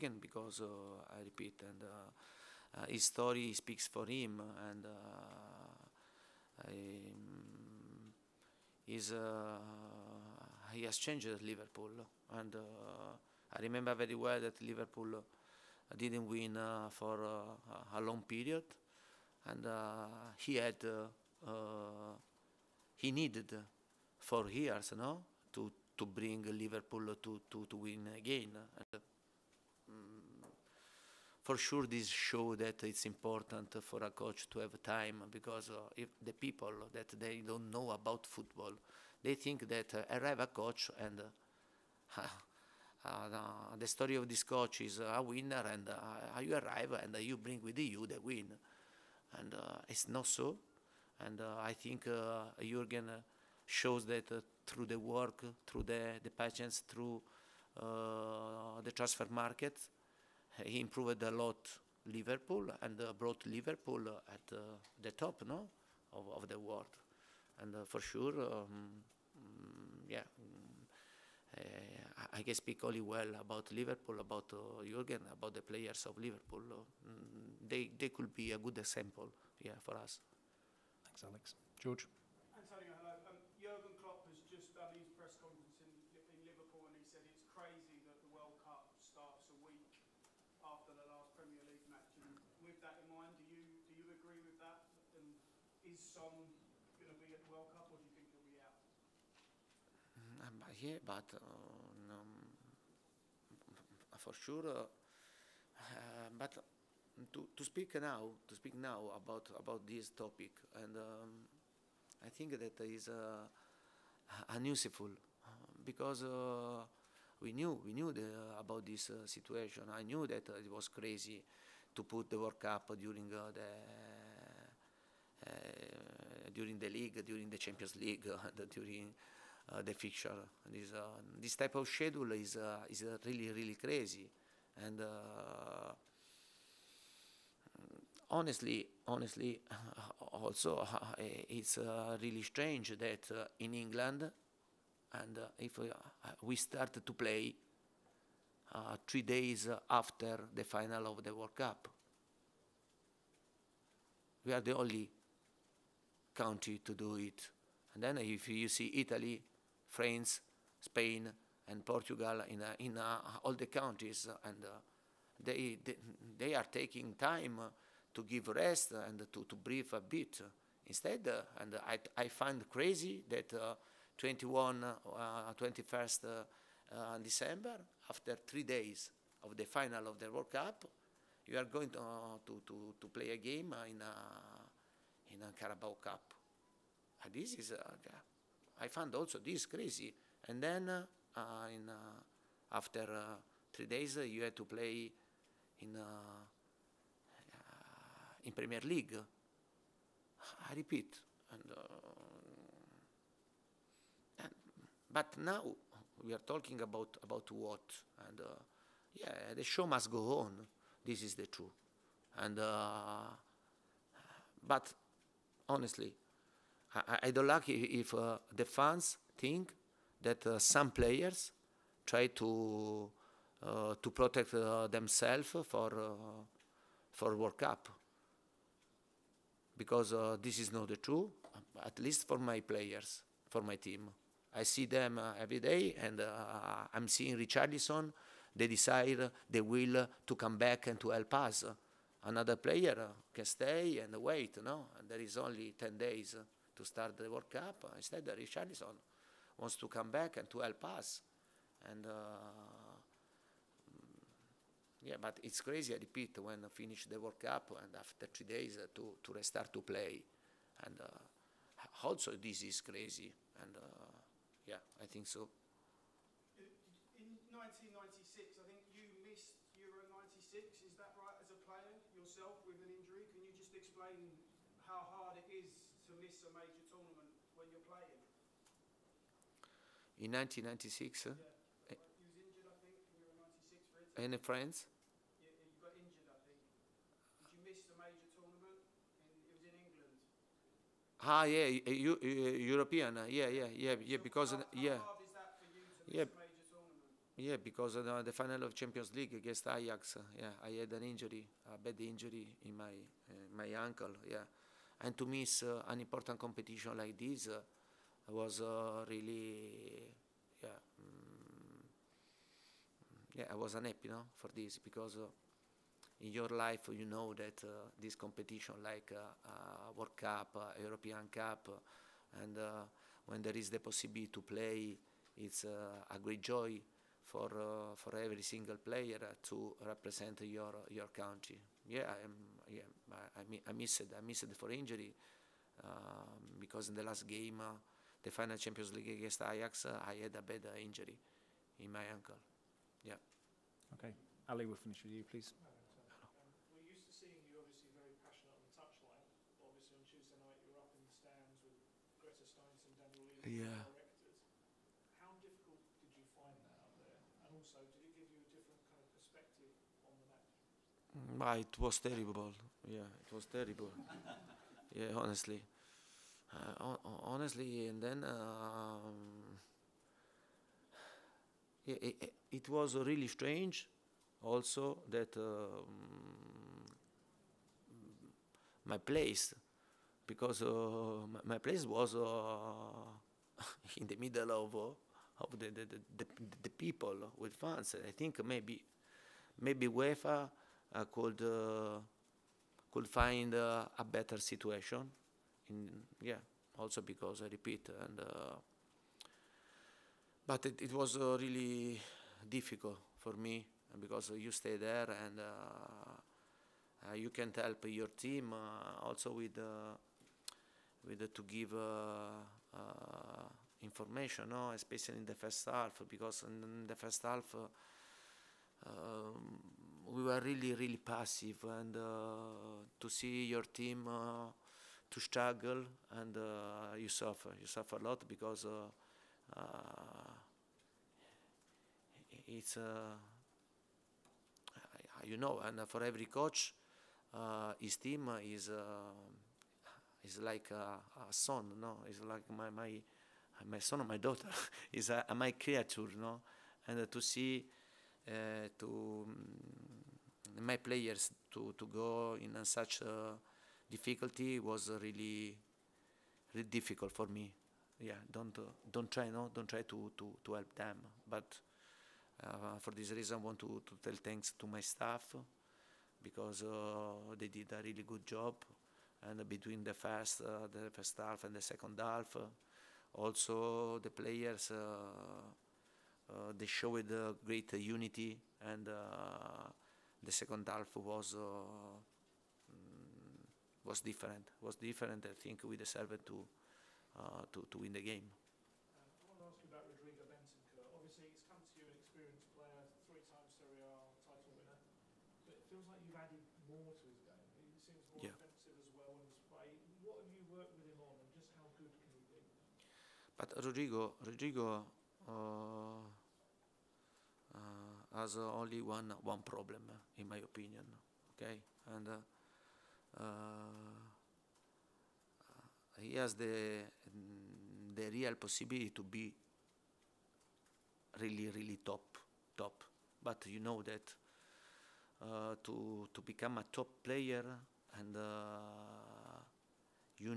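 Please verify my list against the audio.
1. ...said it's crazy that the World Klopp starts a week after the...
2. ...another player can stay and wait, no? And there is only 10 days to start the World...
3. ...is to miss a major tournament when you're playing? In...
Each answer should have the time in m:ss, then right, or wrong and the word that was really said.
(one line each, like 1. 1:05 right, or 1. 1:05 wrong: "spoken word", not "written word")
1. 1:27 wrong: "Cup", not "Klopp"
2. 4:02 right
3. 4:35 right.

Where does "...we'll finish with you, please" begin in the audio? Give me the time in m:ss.
5:44.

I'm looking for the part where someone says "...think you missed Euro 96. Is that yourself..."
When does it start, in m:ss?
4:28.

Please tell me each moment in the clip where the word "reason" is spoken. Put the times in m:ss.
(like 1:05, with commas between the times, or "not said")
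7:43.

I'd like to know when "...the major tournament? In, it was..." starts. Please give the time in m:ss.
4:47.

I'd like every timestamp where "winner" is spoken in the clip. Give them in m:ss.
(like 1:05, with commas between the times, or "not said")
0:45, 8:14.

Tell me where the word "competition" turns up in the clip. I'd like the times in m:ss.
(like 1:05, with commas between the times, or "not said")
5:06, 5:18.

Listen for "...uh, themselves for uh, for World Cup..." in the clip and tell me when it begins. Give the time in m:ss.
3:44.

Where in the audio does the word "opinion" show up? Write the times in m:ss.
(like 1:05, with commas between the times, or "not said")
8:30.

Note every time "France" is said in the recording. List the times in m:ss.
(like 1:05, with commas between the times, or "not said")
2:39, 4:44.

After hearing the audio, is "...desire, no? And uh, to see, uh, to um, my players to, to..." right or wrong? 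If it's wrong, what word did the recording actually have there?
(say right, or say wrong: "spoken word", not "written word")
wrong: "creature", not "desire".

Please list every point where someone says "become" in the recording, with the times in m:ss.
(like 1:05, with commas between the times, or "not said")
8:46.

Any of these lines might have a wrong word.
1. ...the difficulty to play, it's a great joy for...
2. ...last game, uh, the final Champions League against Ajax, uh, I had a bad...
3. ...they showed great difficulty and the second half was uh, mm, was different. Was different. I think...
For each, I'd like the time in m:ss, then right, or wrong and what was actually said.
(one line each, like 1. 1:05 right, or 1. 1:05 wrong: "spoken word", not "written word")
1. 5:23 wrong: "possibility", not "difficulty"
2. 5:37 right
3. 7:56 wrong: "unity", not "difficulty".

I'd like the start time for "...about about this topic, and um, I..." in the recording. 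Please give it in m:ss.
1:49.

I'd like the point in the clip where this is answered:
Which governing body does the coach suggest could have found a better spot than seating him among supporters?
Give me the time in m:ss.
6:29.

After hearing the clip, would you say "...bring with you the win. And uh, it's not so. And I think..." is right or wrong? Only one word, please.
right.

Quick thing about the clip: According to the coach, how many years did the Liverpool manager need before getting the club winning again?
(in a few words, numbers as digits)
4.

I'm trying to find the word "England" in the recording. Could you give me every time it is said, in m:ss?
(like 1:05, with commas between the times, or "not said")
2:23, 4:49.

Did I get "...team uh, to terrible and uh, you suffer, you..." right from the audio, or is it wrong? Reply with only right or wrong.
wrong.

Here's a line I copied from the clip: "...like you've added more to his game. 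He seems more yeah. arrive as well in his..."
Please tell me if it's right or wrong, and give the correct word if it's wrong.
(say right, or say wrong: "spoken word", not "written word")
wrong: "offensive", not "arrive".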